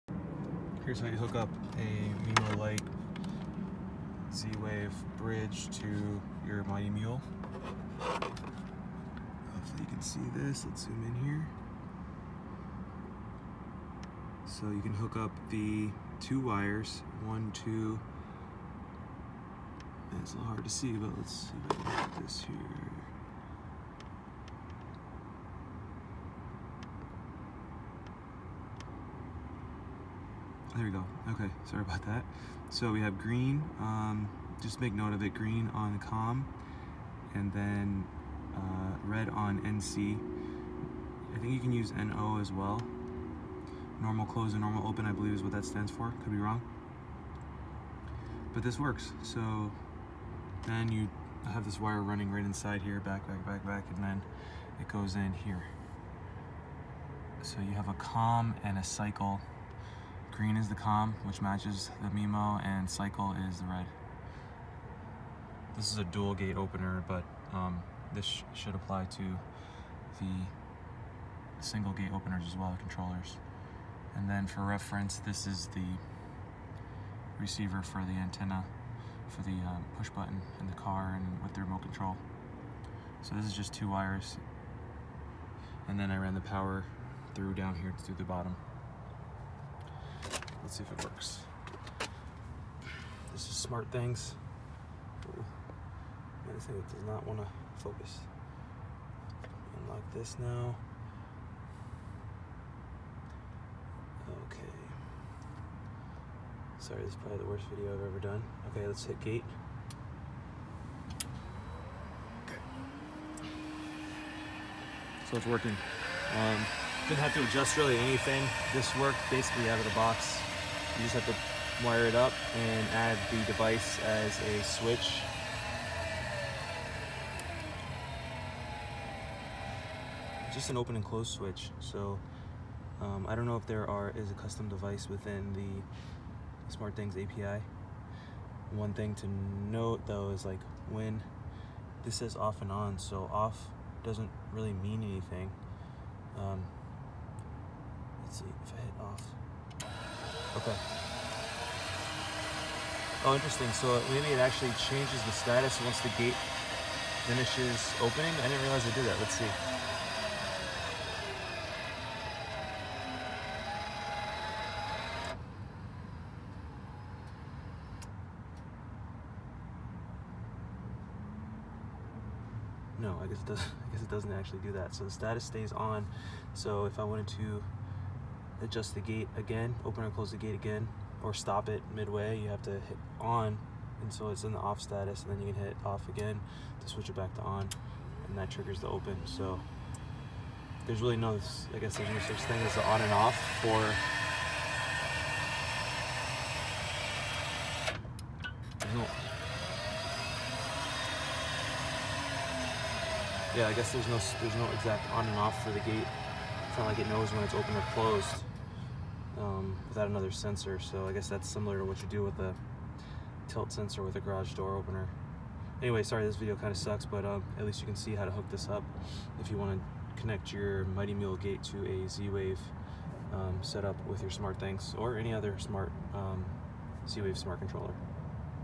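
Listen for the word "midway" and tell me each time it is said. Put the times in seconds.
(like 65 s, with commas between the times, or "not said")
181 s.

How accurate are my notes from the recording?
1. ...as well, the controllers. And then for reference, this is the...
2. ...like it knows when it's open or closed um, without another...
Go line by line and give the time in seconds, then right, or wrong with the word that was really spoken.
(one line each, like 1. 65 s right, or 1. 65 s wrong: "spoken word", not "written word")
1. 72 s right
2. 206 s right.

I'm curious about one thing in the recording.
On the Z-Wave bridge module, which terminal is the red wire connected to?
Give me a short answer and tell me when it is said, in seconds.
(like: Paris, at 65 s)
NC, at 39 s.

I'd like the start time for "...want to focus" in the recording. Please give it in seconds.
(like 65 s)
97 s.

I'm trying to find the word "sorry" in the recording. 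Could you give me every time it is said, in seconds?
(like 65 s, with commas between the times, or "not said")
31 s, 106 s, 216 s.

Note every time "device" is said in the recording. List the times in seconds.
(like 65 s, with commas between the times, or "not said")
123 s, 134 s.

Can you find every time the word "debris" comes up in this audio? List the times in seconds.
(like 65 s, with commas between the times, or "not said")
not said.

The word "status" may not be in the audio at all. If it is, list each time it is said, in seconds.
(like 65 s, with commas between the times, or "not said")
155 s, 175 s, 184 s.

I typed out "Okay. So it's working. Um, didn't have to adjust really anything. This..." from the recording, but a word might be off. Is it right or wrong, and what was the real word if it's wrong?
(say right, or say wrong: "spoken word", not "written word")
right.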